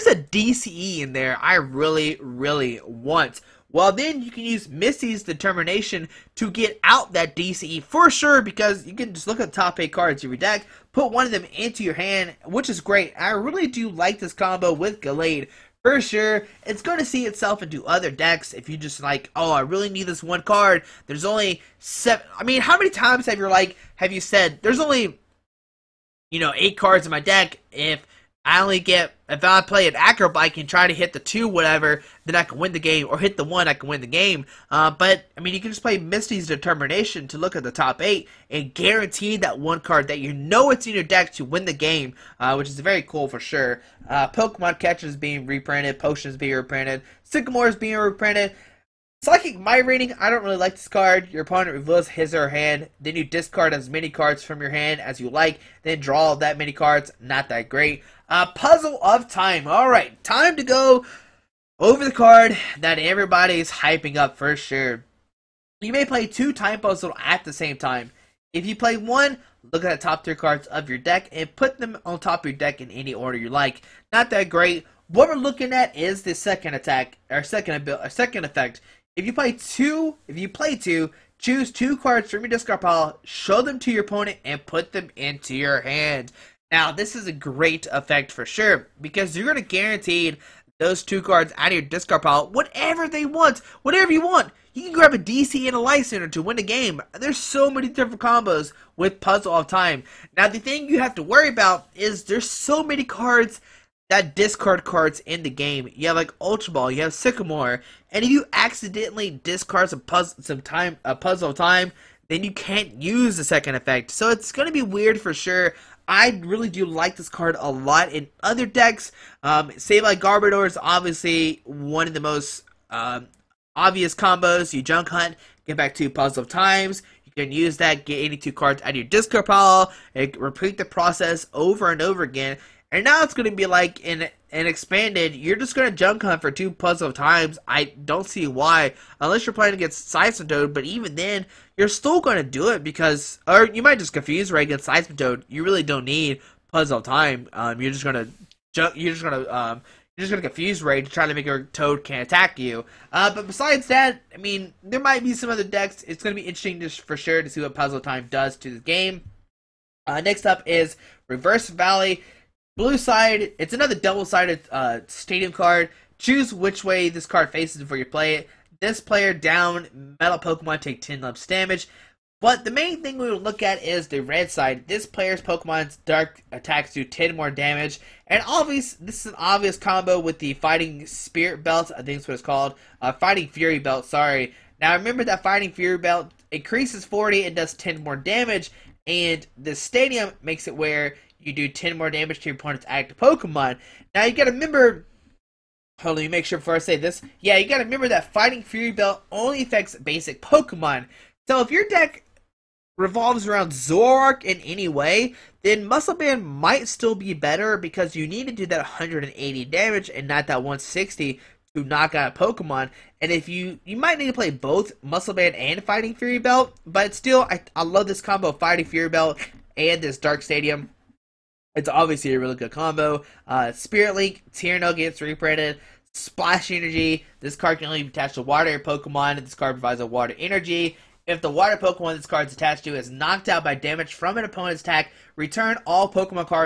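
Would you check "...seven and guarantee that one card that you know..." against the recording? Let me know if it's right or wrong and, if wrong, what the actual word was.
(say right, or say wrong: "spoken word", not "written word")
wrong: "eight", not "seven".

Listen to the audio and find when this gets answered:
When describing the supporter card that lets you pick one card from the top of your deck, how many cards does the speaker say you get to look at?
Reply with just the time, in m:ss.
0:09.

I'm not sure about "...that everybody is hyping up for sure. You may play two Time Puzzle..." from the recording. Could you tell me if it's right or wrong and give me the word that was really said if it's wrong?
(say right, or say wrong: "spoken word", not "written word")
right.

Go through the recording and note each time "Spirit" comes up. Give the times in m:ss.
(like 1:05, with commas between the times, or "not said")
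3:01, 3:43.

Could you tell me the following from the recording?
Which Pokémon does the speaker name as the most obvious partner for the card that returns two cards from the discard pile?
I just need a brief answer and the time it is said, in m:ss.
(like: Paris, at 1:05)
Garbodor, at 2:00.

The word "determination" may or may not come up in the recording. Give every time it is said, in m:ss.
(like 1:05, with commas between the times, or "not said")
0:05, 0:36.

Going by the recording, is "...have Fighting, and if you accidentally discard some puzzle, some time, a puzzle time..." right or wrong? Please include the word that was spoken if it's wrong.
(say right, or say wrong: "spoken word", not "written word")
wrong: "Sycamore", not "Fighting".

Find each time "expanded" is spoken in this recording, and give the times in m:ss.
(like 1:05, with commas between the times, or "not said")
2:14.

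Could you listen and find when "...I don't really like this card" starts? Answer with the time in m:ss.
0:50.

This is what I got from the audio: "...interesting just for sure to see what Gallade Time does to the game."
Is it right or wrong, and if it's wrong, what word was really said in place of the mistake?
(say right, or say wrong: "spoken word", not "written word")
wrong: "Puzzle", not "Gallade".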